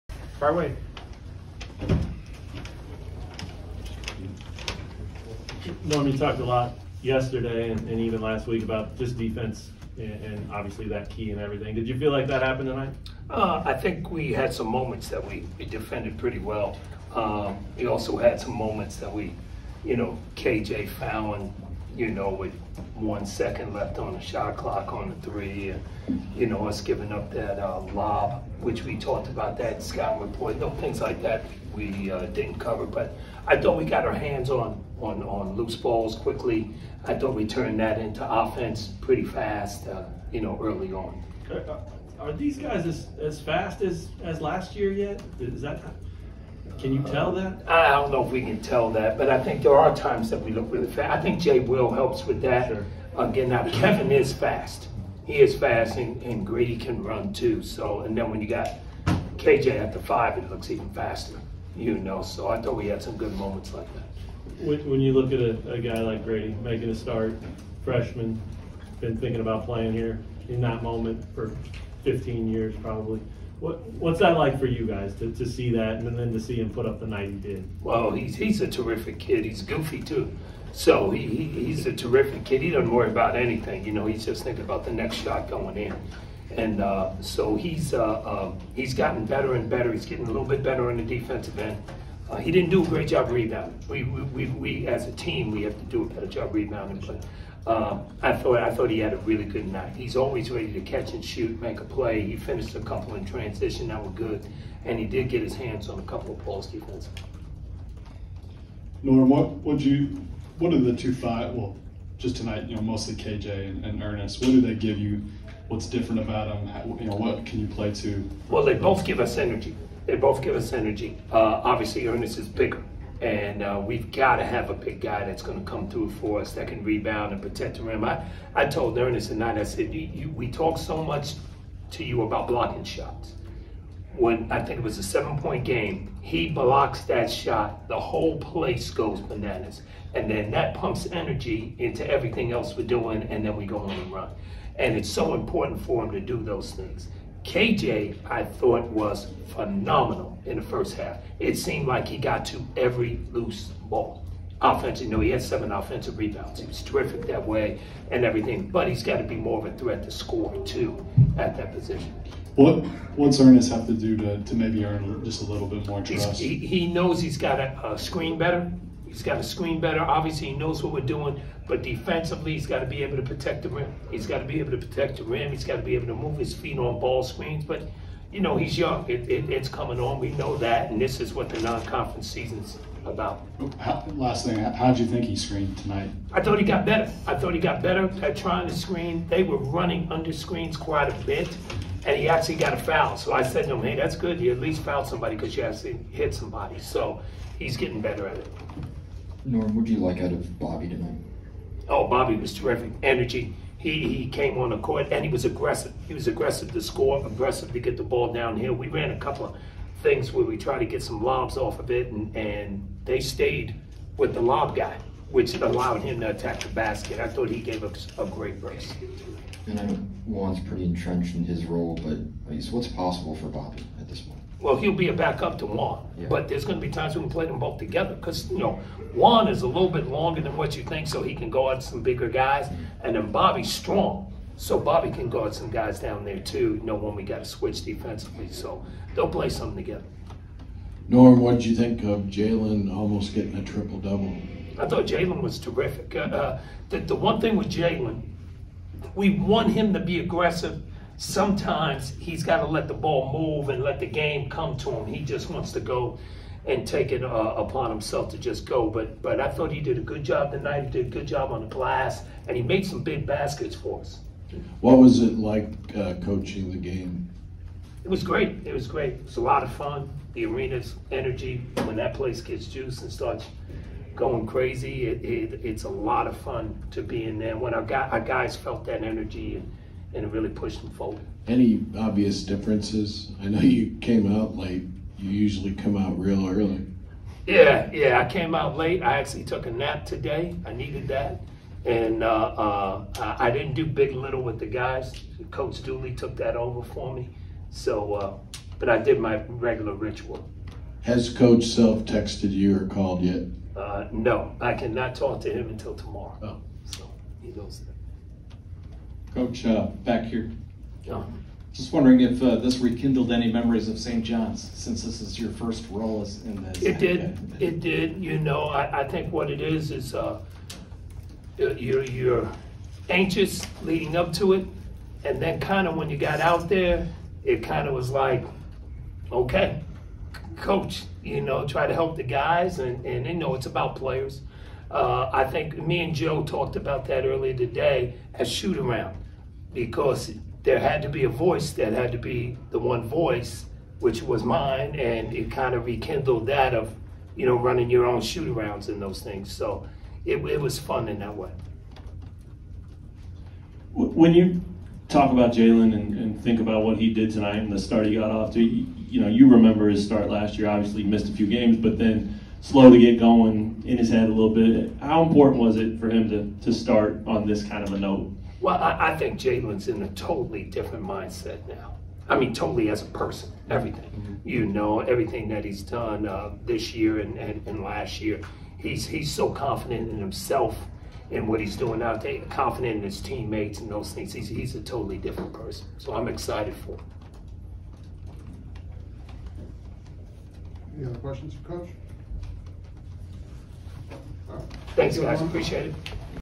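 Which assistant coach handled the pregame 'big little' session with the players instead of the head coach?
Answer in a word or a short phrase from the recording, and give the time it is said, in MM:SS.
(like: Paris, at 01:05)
Coach Dooley, at 04:55.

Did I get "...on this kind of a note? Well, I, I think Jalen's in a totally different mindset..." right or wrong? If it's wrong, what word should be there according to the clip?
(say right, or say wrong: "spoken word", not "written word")
right.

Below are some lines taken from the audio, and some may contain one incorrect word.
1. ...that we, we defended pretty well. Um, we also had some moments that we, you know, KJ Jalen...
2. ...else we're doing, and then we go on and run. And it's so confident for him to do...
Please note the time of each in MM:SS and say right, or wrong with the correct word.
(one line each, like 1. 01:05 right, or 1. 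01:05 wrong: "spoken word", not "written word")
1. 00:15 wrong: "Fallon", not "Jalen"
2. 02:22 wrong: "important", not "confident".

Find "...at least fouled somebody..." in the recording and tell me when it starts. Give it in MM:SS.
03:14.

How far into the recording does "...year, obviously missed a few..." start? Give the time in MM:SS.
06:00.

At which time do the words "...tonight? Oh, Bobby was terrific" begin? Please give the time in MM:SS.
03:20.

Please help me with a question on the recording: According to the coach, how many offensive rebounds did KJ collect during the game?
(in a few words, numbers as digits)
7.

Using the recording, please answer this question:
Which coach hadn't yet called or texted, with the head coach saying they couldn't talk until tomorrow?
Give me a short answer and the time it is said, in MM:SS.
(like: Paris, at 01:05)
Coach Self, at 05:01.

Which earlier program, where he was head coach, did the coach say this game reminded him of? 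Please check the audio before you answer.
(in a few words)
St. John's.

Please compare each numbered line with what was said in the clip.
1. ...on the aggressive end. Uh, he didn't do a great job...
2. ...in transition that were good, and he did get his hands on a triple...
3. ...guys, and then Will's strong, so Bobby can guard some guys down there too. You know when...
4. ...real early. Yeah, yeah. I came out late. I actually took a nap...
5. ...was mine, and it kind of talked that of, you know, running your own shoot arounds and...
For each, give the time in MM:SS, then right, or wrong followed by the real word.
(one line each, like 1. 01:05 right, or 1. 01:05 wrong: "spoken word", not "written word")
1. 01:30 wrong: "defensive", not "aggressive"
2. 01:43 wrong: "couple", not "triple"
3. 03:52 wrong: "Bobby", not "Will"
4. 04:46 right
5. 05:44 wrong: "rekindled", not "talked".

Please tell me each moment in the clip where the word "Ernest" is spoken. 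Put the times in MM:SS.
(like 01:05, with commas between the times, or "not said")
01:54, 02:02, 02:08, 02:43.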